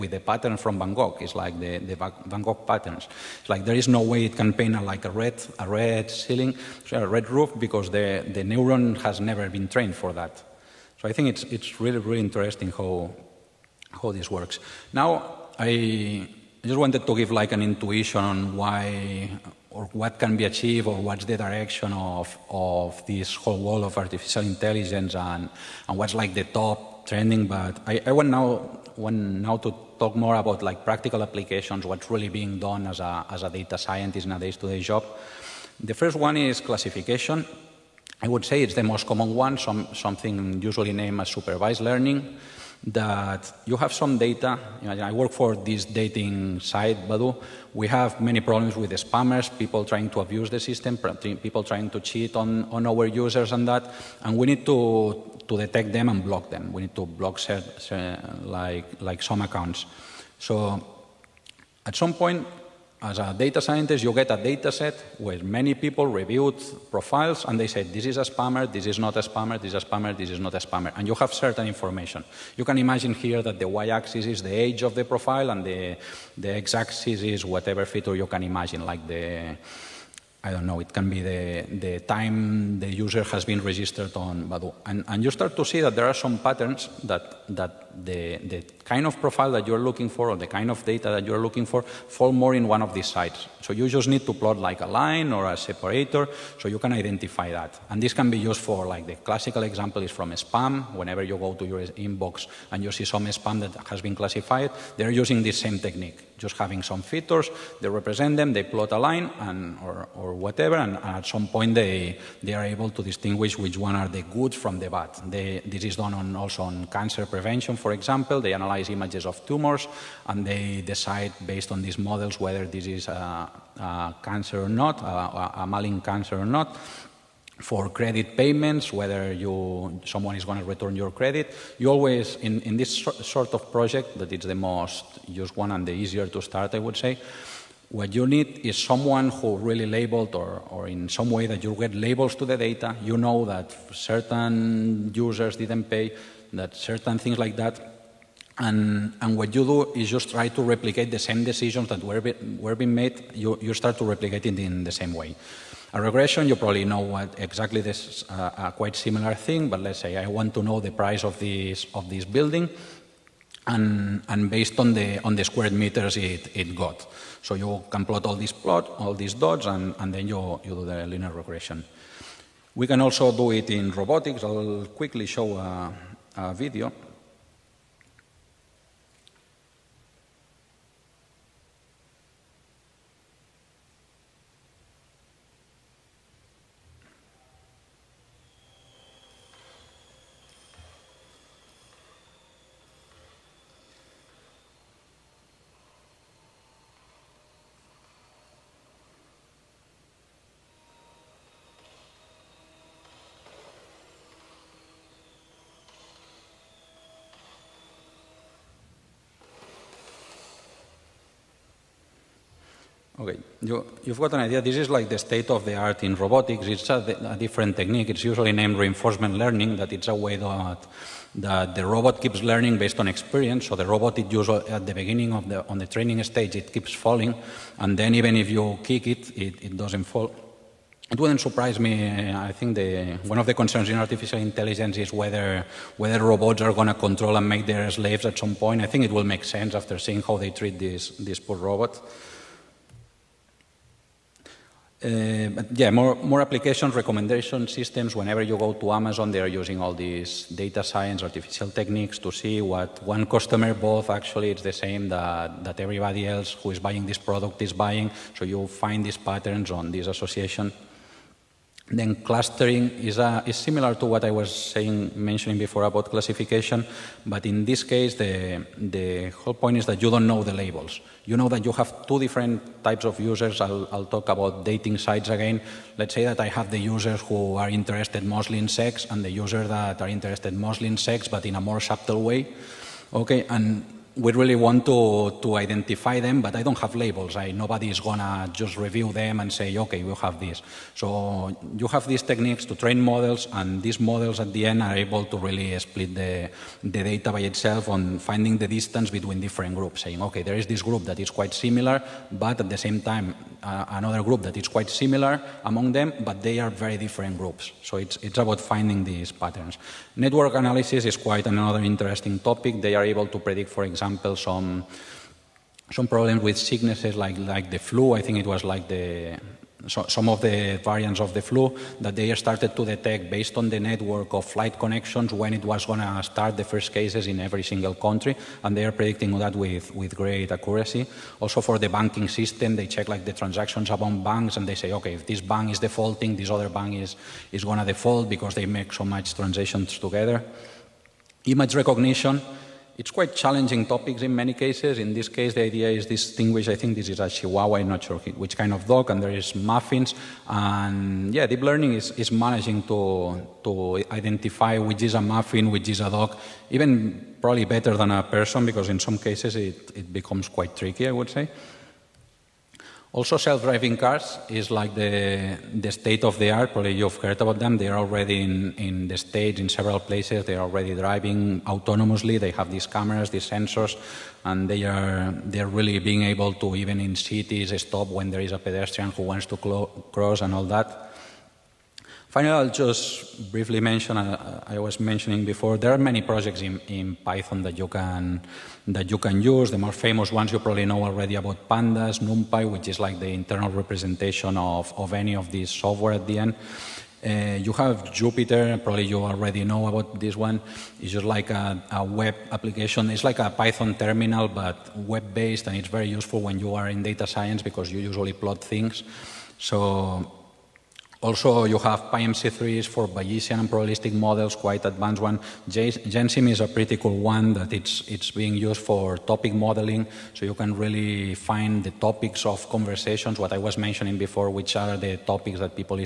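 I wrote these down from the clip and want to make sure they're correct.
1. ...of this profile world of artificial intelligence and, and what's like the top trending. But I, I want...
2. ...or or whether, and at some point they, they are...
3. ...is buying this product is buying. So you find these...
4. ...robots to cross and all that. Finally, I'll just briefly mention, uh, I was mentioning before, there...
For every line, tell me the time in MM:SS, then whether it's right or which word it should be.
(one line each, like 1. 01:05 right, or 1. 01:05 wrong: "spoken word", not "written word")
1. 00:22 wrong: "whole", not "profile"
2. 01:50 wrong: "whatever", not "whether"
3. 04:16 right
4. 06:19 wrong: "wants", not "robots".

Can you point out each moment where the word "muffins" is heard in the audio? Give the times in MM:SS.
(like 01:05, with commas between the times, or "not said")
05:49, 05:55.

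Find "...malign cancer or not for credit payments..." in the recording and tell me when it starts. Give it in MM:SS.
02:05.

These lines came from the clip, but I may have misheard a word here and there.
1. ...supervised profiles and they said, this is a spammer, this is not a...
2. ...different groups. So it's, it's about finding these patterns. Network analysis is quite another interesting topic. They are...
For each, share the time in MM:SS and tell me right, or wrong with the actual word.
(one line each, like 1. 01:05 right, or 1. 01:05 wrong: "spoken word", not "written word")
1. 01:06 wrong: "reviewed", not "supervised"
2. 05:06 right.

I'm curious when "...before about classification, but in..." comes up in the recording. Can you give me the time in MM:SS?
04:25.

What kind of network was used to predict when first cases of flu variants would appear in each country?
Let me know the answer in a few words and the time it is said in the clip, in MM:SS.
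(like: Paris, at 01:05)
flight connections, at 05:24.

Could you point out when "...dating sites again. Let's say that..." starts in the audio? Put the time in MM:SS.
04:34.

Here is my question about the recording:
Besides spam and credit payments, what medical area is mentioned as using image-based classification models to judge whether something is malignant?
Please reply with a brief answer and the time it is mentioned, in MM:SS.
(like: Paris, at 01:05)
cancer prevention, at 01:56.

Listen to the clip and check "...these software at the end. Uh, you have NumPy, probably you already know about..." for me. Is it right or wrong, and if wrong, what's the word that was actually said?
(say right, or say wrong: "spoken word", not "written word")
wrong: "Jupyter", not "NumPy".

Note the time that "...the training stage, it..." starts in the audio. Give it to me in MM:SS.
03:45.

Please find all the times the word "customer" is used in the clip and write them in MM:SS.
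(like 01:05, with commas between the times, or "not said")
04:13.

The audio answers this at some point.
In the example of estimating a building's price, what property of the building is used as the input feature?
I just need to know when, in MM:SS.
02:45.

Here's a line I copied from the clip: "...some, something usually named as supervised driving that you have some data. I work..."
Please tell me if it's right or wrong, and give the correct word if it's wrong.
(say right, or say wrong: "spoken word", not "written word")
wrong: "learning", not "driving".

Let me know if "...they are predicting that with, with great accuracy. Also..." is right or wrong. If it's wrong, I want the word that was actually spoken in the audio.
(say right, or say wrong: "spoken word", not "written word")
right.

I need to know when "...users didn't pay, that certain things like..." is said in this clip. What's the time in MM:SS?
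02:25.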